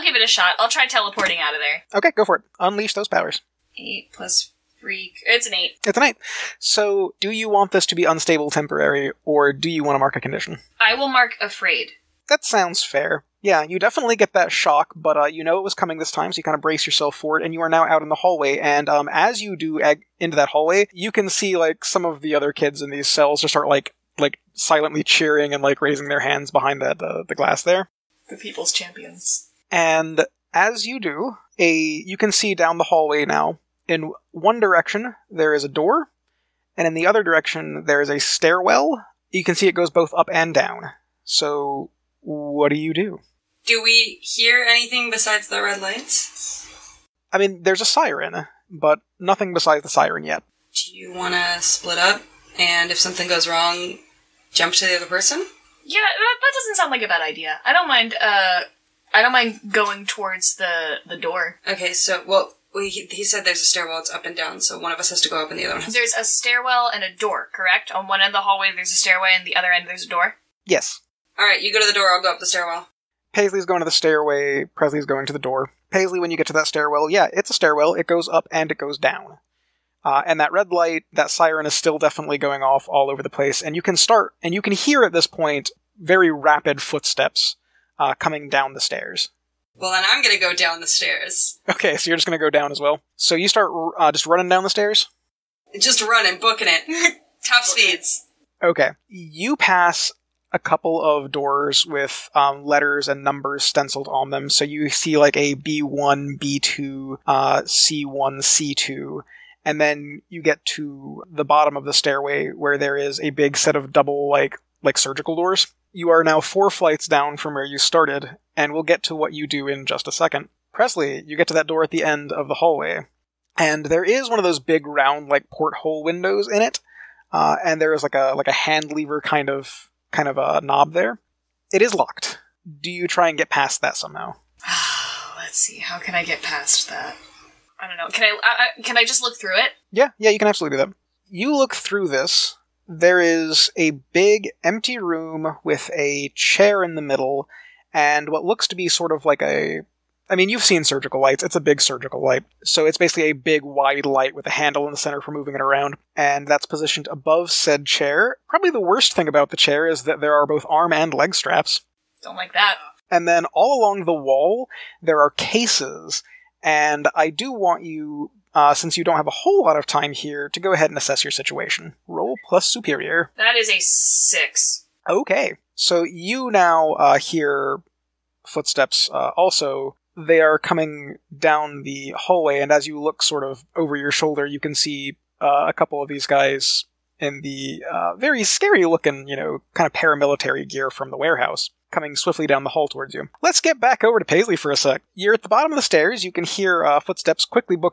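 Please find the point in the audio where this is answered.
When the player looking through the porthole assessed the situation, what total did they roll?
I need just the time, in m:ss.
2:53.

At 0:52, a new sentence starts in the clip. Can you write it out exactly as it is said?
And if something goes wrong, jump to the other person?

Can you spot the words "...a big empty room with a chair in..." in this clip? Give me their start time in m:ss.
2:23.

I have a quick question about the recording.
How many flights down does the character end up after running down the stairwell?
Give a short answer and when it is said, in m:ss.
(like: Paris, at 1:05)
4, at 1:56.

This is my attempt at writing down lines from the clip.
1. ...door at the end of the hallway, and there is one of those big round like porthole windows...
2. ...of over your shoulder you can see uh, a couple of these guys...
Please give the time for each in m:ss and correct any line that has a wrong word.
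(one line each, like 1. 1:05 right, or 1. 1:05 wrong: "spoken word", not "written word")
1. 2:01 right
2. 3:03 right.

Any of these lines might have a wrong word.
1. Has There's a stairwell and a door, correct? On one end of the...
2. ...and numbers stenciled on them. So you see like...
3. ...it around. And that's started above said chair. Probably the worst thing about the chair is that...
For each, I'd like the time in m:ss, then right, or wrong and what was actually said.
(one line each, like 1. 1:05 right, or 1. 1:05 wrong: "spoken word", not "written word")
1. 1:05 right
2. 1:43 right
3. 2:35 wrong: "positioned", not "started".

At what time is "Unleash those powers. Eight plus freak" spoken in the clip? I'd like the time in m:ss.
0:02.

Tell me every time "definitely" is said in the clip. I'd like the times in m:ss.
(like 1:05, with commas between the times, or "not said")
0:13, 1:21.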